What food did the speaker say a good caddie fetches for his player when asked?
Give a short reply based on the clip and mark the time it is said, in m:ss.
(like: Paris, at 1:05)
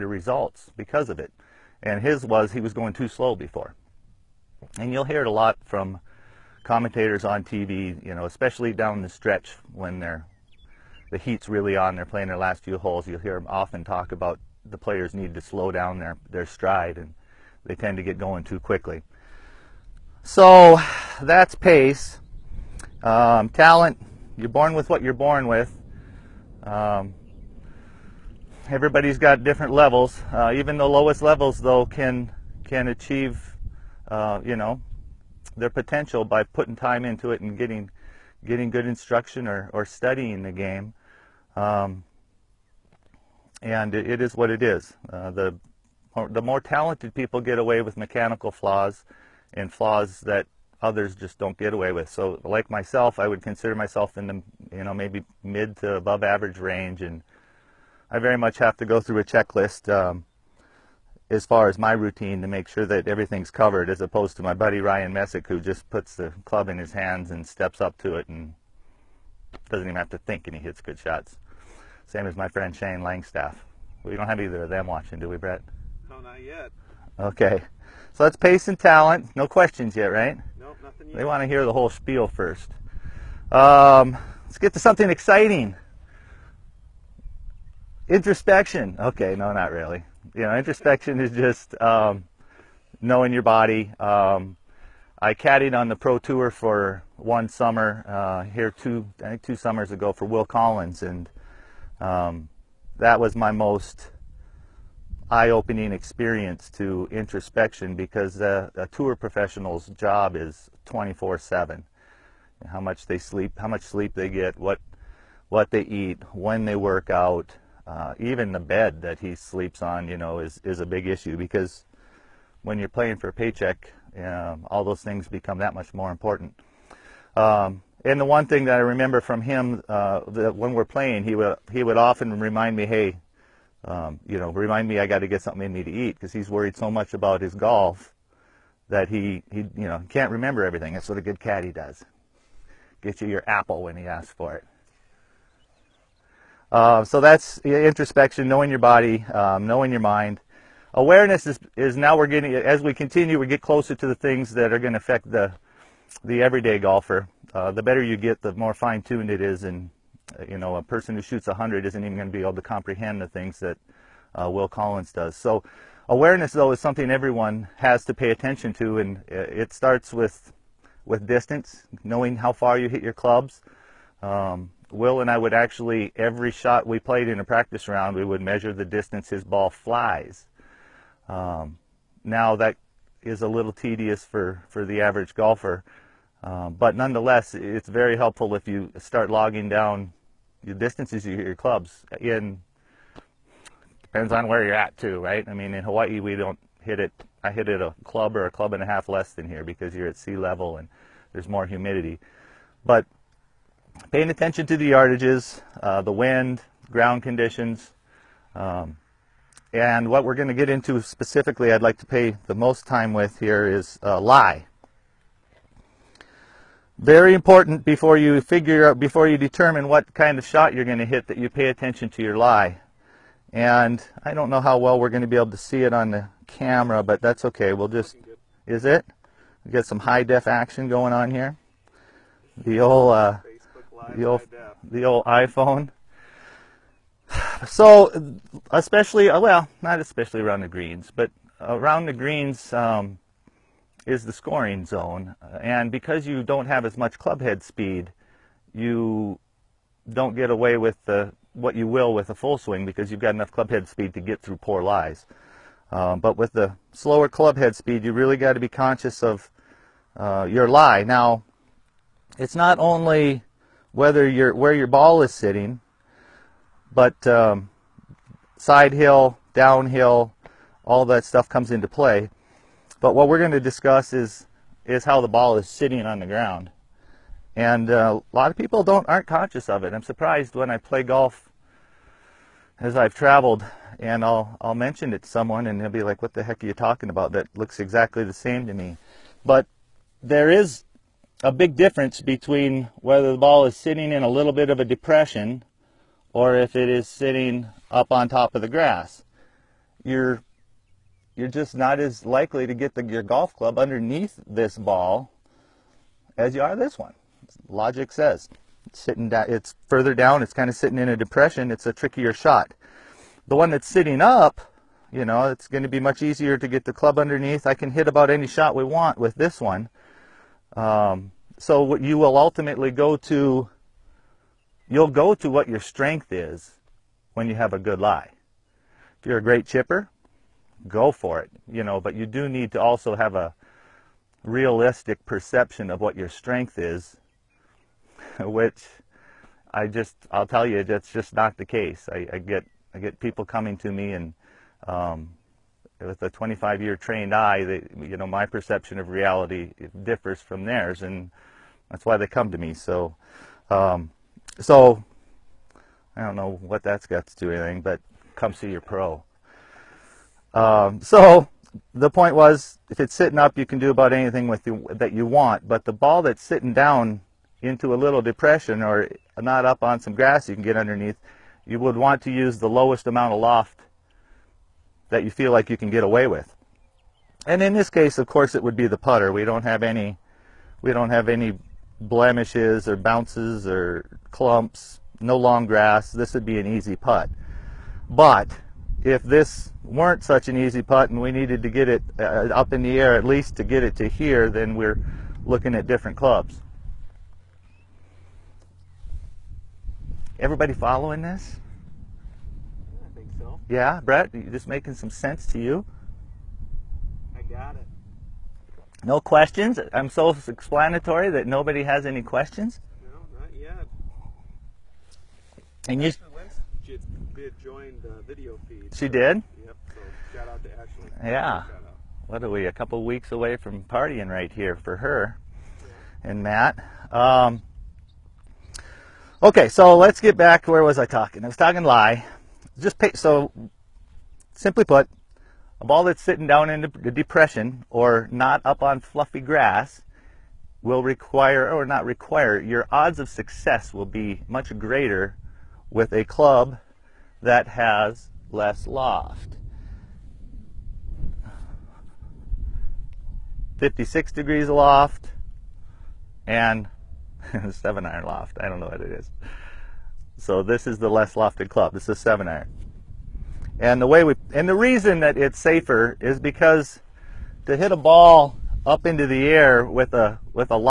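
apple, at 2:23.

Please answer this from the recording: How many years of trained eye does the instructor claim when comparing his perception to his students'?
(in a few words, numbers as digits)
25.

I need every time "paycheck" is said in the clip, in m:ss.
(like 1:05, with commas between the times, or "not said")
2:03.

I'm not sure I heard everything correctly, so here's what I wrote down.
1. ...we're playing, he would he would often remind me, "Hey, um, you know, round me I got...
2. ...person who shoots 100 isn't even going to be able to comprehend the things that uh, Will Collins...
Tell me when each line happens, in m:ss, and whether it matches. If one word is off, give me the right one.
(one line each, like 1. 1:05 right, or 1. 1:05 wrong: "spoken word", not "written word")
1. 2:10 wrong: "remind", not "round"
2. 2:40 right.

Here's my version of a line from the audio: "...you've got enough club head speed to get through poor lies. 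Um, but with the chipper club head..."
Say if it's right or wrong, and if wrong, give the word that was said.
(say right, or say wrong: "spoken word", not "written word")
wrong: "slower", not "chipper".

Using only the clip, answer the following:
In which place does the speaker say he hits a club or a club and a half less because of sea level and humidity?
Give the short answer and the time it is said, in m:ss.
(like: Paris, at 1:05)
Hawaii, at 3:15.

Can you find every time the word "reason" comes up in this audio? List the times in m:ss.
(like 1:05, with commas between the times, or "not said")
7:44.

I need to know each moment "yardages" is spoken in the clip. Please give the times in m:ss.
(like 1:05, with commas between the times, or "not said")
3:24.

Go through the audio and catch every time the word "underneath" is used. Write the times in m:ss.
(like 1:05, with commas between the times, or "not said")
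5:03, 5:17, 6:10.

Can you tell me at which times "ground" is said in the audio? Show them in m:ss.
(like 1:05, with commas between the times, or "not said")
3:26, 4:36.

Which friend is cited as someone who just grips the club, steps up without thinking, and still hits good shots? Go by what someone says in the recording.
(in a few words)
Ryan Messick.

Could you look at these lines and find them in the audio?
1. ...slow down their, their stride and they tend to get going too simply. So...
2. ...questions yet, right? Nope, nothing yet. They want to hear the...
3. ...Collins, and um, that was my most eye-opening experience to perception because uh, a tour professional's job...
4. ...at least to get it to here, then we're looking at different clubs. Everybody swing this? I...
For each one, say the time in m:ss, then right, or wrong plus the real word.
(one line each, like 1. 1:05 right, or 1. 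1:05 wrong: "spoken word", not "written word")
1. 0:15 wrong: "quickly", not "simply"
2. 1:19 right
3. 1:40 wrong: "introspection", not "perception"
4. 6:33 wrong: "following", not "swing".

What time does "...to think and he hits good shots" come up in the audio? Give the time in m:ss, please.
1:10.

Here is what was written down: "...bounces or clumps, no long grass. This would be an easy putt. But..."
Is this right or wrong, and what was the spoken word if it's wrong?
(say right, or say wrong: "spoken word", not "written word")
right.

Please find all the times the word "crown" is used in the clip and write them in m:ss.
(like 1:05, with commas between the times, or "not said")
not said.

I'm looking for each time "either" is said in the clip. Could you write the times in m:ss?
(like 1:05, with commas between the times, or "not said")
1:14.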